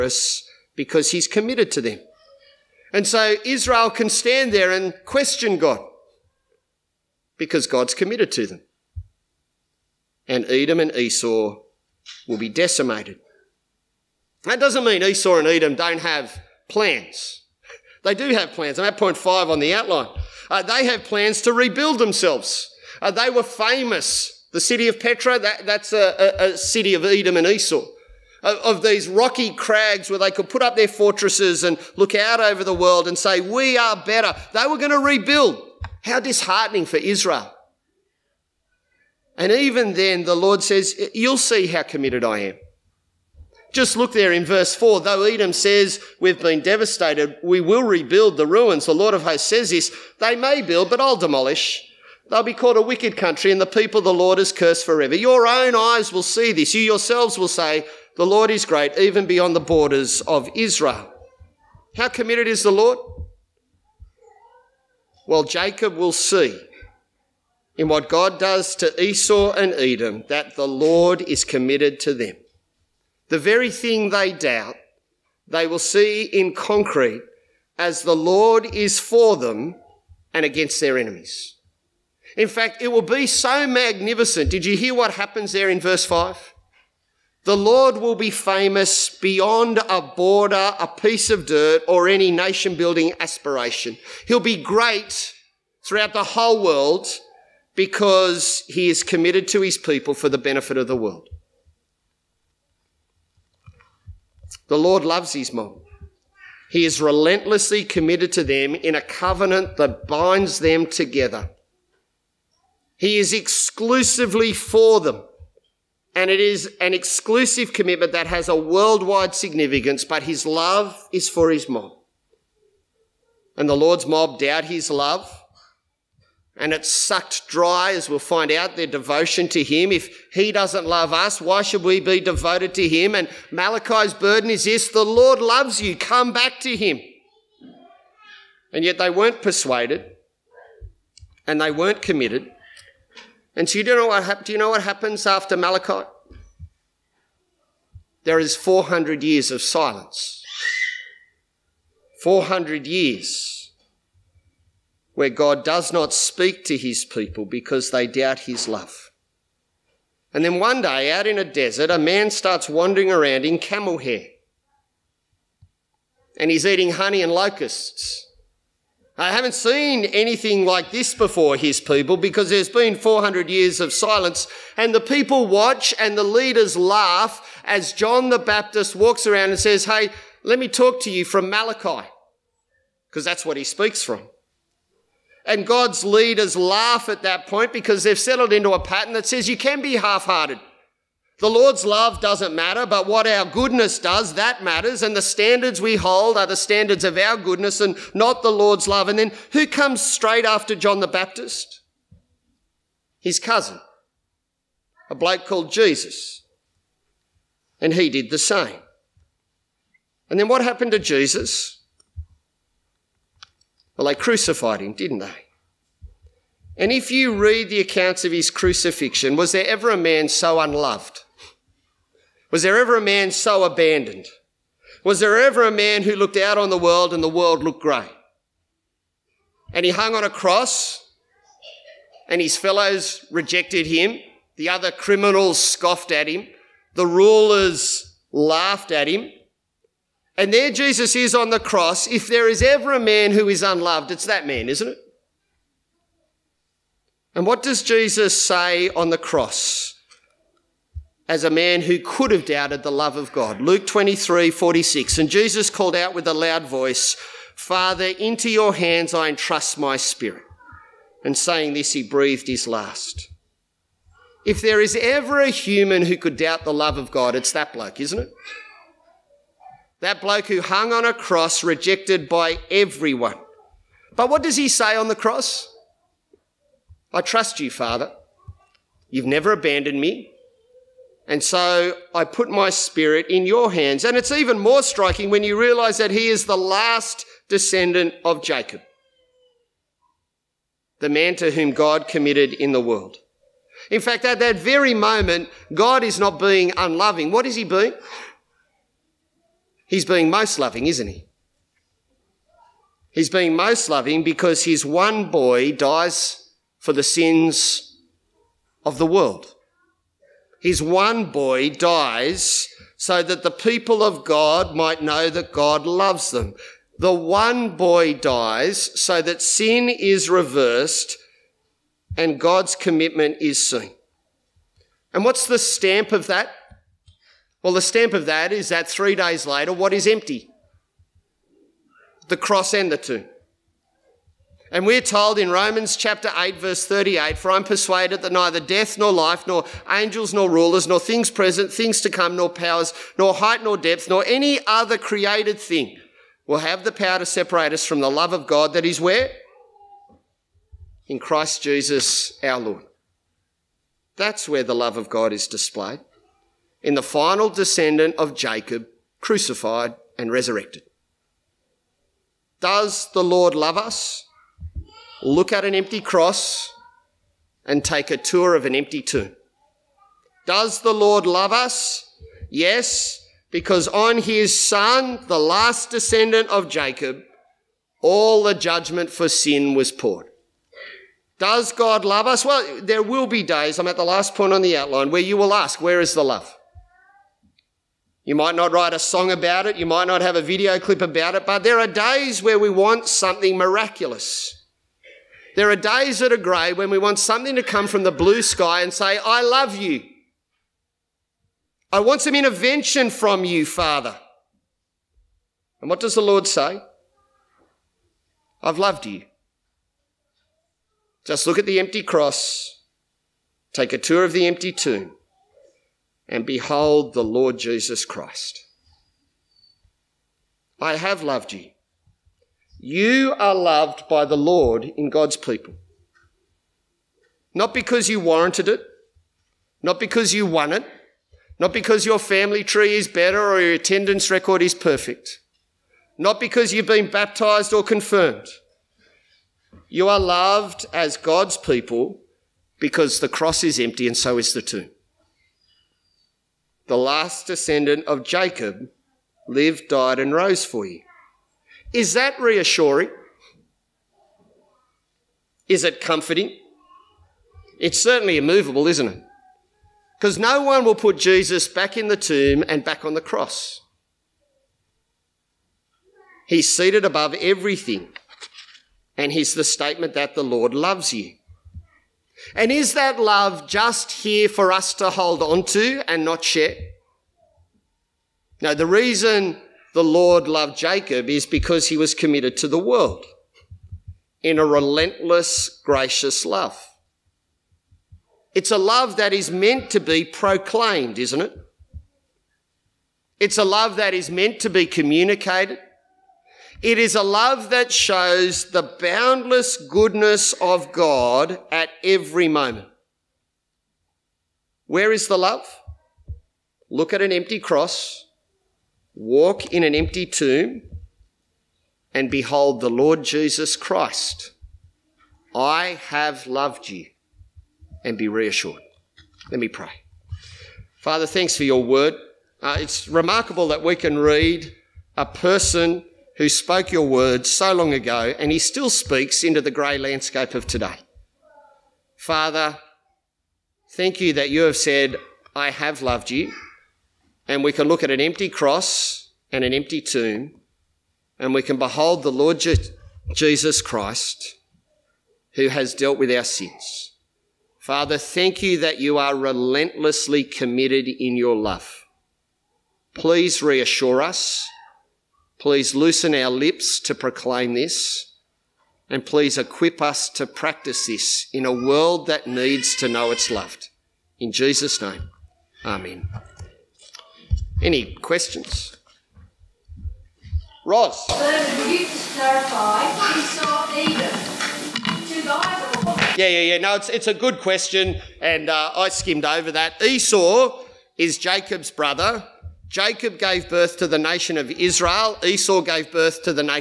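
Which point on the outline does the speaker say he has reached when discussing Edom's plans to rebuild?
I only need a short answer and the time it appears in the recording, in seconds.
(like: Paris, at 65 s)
Point 5, at 18 s.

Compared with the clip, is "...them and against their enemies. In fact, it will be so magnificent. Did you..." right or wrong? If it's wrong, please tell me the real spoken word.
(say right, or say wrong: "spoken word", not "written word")
right.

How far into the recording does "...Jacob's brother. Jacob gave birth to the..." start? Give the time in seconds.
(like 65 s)
581 s.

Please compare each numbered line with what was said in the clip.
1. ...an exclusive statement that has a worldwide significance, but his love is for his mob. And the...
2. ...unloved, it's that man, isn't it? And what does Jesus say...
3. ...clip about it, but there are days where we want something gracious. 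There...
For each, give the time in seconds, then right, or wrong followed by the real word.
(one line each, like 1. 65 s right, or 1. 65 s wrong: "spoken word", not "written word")
1. 116 s wrong: "commitment", not "statement"
2. 243 s right
3. 390 s wrong: "miraculous", not "gracious".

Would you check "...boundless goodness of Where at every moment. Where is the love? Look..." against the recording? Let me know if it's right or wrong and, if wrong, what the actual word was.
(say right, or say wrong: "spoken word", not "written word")
wrong: "God", not "Where".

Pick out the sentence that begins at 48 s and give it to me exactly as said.
The Lord of hosts says this.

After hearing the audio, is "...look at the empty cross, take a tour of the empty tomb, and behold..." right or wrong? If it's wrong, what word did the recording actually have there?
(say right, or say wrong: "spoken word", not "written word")
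right.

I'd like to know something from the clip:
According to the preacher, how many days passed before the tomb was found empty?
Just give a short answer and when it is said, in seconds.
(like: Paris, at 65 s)
3, at 328 s.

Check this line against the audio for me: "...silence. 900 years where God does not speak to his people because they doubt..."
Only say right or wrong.
wrong.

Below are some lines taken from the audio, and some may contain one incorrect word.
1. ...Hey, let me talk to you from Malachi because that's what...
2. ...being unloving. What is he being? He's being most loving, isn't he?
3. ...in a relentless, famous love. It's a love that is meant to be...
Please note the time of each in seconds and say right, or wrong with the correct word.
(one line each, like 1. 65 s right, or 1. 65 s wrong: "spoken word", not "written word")
1. 179 s right
2. 296 s right
3. 484 s wrong: "gracious", not "famous".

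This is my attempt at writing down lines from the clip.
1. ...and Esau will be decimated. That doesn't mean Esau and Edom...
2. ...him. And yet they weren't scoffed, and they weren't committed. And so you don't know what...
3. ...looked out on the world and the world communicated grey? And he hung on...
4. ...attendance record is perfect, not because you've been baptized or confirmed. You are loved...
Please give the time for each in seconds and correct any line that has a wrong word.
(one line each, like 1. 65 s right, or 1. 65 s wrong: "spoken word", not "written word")
1. 10 s right
2. 136 s wrong: "persuaded", not "scoffed"
3. 226 s wrong: "looked", not "communicated"
4. 433 s right.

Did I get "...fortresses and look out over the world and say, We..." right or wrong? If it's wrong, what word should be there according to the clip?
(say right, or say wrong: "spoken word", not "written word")
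right.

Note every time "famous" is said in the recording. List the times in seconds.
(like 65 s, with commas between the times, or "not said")
23 s, 88 s.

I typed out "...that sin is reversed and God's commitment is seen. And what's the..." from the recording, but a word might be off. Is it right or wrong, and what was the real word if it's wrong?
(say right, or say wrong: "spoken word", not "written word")
right.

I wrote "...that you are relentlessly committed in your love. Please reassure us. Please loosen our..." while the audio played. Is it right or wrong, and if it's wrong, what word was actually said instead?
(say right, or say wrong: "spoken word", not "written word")
right.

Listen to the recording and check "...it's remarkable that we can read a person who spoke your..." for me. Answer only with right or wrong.
right.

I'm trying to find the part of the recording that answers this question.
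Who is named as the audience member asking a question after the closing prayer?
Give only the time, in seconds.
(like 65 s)
570 s.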